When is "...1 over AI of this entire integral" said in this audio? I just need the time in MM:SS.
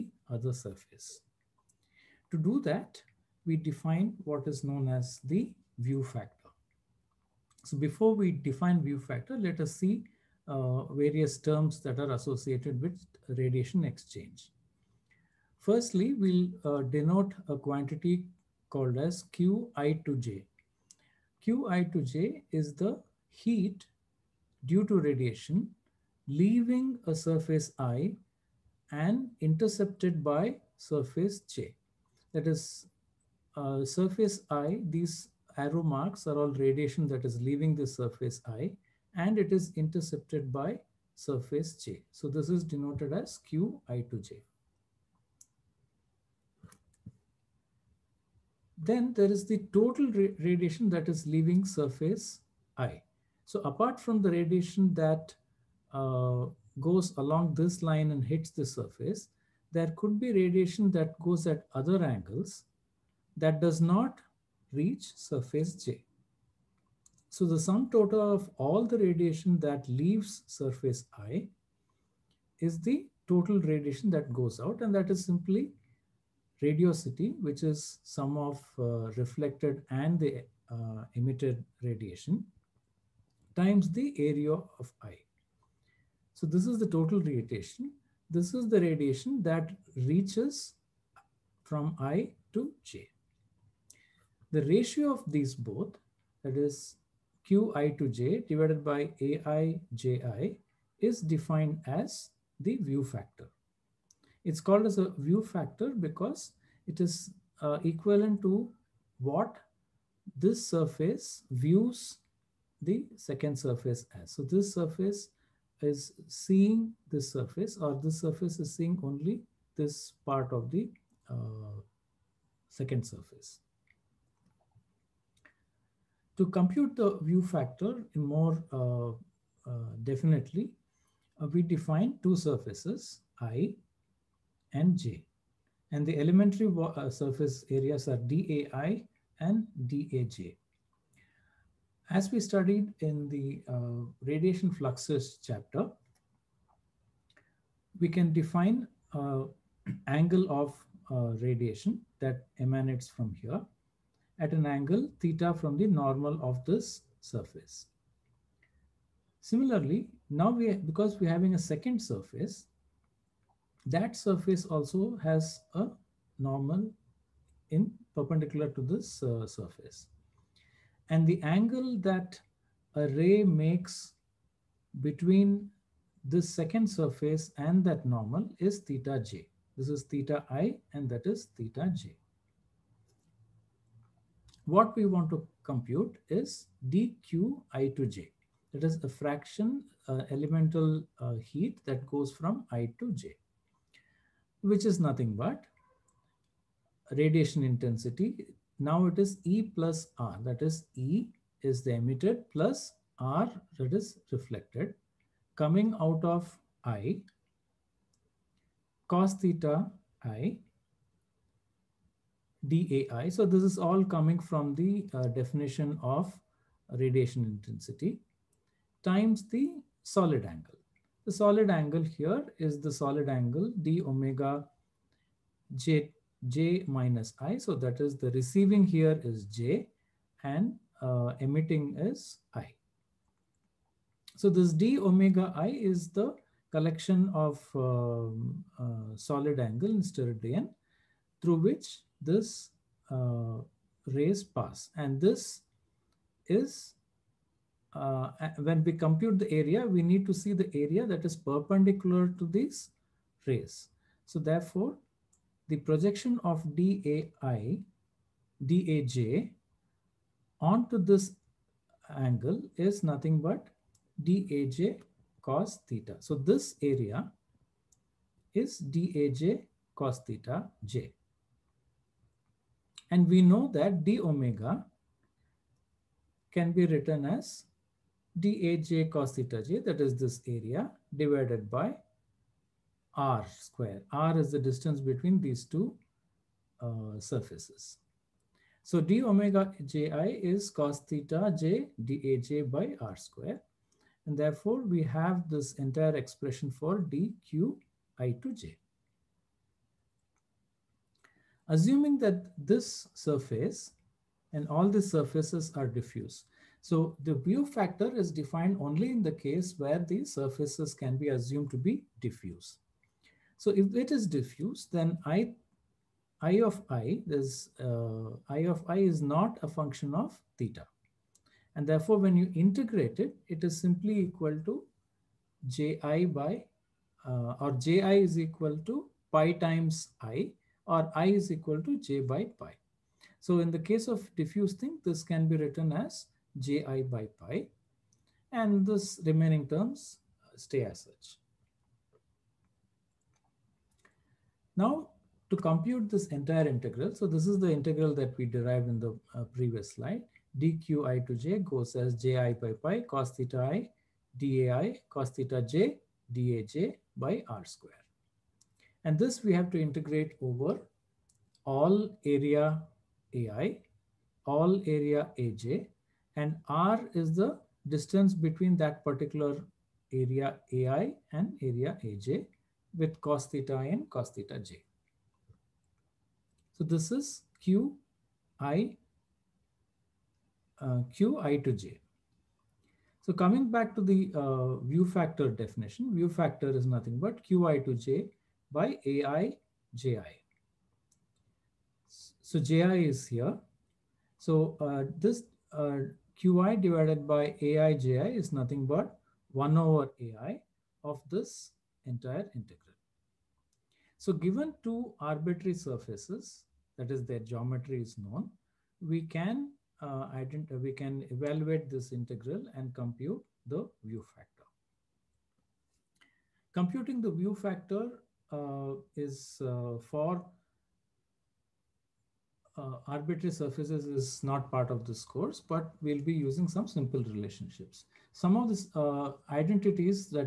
06:39.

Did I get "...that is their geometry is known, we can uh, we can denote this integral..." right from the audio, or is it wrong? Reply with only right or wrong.
wrong.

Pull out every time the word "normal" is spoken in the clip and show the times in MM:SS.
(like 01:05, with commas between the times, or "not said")
02:35, 02:46, 02:58.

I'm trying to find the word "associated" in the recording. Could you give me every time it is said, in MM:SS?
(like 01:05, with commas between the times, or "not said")
00:12.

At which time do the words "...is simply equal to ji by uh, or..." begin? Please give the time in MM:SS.
05:23.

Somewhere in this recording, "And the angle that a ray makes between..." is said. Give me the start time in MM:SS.
02:51.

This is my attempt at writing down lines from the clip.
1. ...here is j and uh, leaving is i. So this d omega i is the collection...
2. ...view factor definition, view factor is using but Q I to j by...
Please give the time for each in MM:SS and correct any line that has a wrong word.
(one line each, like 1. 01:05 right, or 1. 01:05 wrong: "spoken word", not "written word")
1. 03:48 wrong: "emitting", not "leaving"
2. 06:24 wrong: "nothing", not "using".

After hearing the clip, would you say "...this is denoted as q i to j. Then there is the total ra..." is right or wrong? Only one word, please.
right.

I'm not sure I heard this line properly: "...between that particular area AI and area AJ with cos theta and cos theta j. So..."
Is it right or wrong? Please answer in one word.
right.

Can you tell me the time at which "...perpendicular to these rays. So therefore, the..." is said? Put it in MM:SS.
04:11.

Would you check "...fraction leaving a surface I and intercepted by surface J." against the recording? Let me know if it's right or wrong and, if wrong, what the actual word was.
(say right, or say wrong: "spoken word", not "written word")
wrong: "radiation", not "fraction".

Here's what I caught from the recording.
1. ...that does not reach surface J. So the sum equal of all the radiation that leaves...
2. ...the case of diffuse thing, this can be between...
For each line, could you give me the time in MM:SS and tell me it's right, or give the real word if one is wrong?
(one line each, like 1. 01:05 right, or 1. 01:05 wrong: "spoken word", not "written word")
1. 01:03 wrong: "total", not "equal"
2. 05:33 wrong: "written", not "between".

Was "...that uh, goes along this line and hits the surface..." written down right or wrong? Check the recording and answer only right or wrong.
right.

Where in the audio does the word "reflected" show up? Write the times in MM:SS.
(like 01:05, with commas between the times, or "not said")
01:19, 03:24.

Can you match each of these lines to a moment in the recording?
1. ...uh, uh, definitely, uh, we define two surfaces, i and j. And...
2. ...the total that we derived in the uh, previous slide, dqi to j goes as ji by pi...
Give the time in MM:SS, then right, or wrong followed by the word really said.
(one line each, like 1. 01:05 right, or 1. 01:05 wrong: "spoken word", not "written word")
1. 02:08 right
2. 05:47 wrong: "integral", not "total".